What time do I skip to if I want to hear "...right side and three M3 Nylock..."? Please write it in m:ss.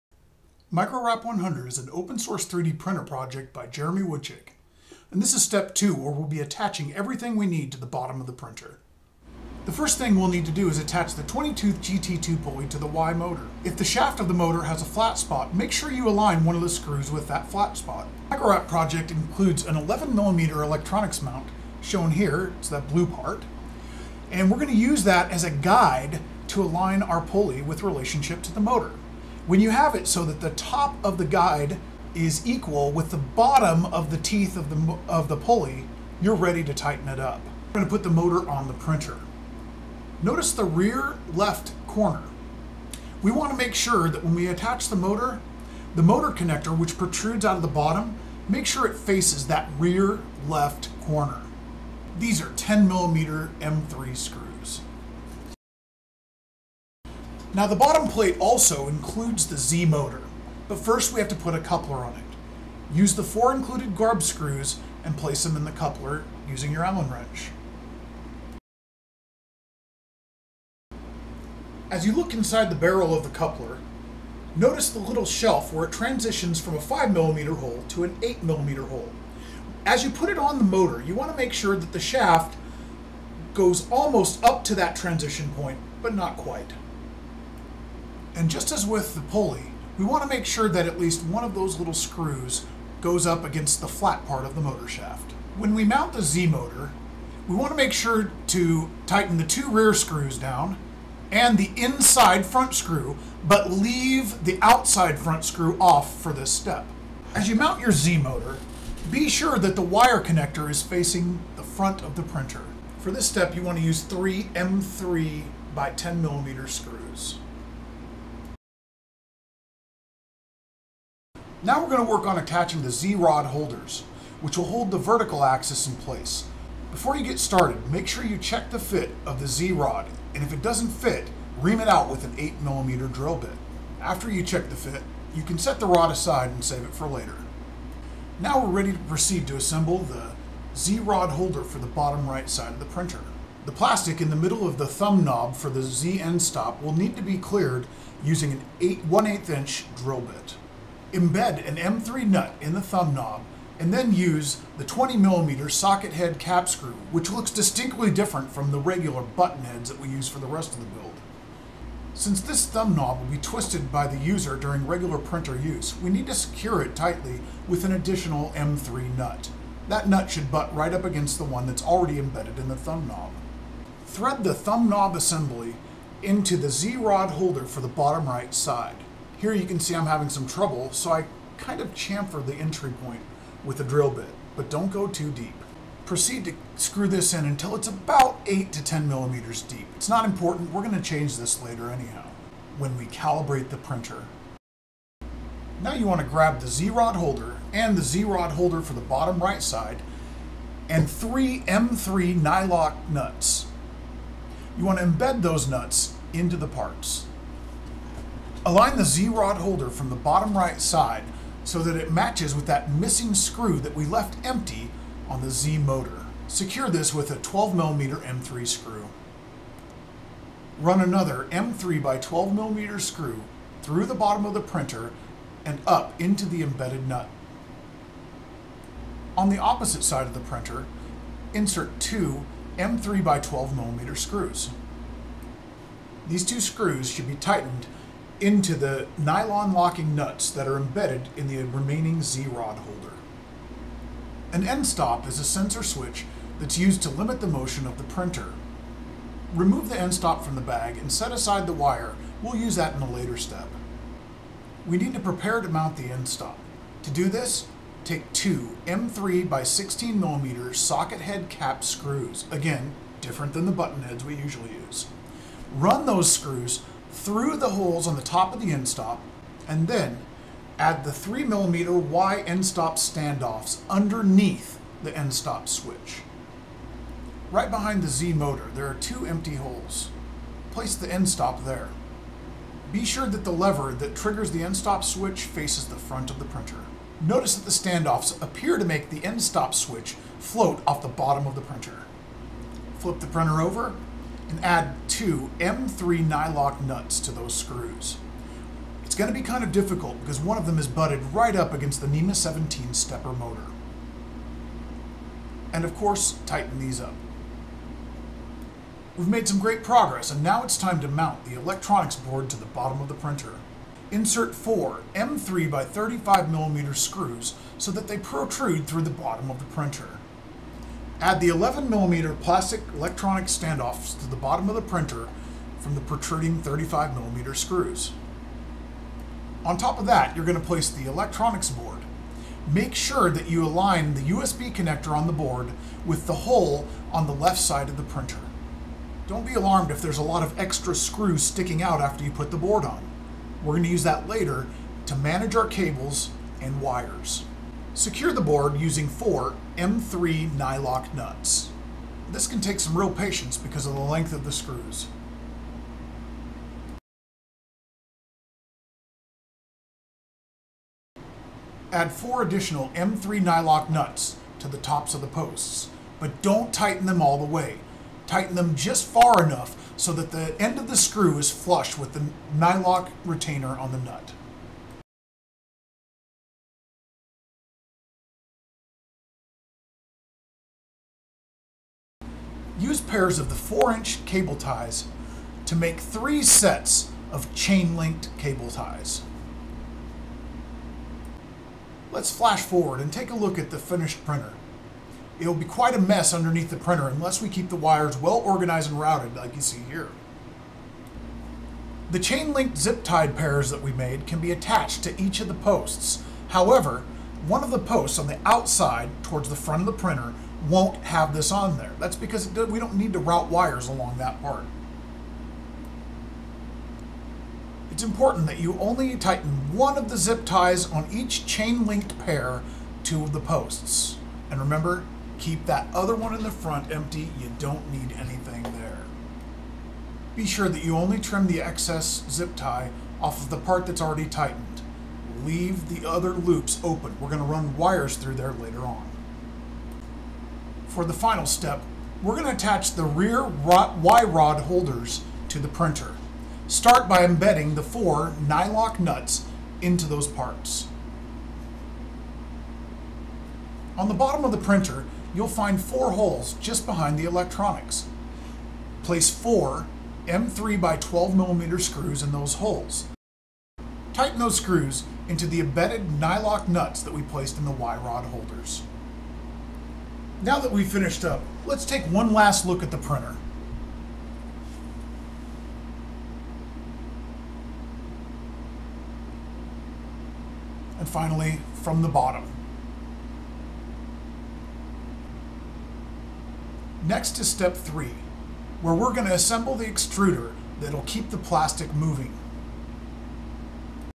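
3:19.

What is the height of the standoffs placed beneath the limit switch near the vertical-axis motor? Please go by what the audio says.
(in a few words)
3mm.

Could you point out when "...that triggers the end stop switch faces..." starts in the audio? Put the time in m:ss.
4:43.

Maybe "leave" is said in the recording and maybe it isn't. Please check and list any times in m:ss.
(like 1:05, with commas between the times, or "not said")
1:43, 7:15.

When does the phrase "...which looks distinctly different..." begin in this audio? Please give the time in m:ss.
2:37.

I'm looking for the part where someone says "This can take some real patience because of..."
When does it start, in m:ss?
5:52.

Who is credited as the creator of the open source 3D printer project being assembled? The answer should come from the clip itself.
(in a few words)
Jeremy Woodchick.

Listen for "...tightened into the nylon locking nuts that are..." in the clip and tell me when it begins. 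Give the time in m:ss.
3:57.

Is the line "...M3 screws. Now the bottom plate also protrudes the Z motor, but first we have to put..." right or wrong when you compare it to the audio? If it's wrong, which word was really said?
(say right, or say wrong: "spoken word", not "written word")
wrong: "includes", not "protrudes".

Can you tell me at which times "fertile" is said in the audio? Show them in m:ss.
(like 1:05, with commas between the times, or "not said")
not said.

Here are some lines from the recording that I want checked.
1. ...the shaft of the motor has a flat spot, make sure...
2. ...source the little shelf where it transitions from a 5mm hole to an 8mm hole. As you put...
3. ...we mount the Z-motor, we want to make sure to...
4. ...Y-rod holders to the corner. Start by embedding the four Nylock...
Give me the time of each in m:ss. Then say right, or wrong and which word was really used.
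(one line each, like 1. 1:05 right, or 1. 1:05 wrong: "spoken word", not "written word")
1. 0:13 right
2. 1:14 wrong: "notice", not "source"
3. 1:35 right
4. 7:23 wrong: "printer", not "corner".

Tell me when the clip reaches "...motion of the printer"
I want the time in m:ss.
4:07.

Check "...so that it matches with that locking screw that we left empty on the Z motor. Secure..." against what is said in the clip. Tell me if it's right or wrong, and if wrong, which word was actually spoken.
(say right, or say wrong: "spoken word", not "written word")
wrong: "missing", not "locking".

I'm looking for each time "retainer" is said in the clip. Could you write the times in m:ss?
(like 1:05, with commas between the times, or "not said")
6:13.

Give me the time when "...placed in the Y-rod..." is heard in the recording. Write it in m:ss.
7:47.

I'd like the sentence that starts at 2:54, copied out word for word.
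Thread the thumb knob assembly into the Z-rod holder for the bottom right side.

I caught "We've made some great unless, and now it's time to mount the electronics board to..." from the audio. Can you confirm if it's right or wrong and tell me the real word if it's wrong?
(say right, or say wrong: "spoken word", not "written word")
wrong: "progress", not "unless".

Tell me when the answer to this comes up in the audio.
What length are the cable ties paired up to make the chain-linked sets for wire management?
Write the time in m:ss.
6:23.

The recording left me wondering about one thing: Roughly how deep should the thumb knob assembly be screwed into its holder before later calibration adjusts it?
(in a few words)
8 to 10 millimeters.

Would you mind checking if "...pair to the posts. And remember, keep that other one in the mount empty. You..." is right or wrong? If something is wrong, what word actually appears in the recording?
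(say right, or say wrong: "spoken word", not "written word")
wrong: "front", not "mount".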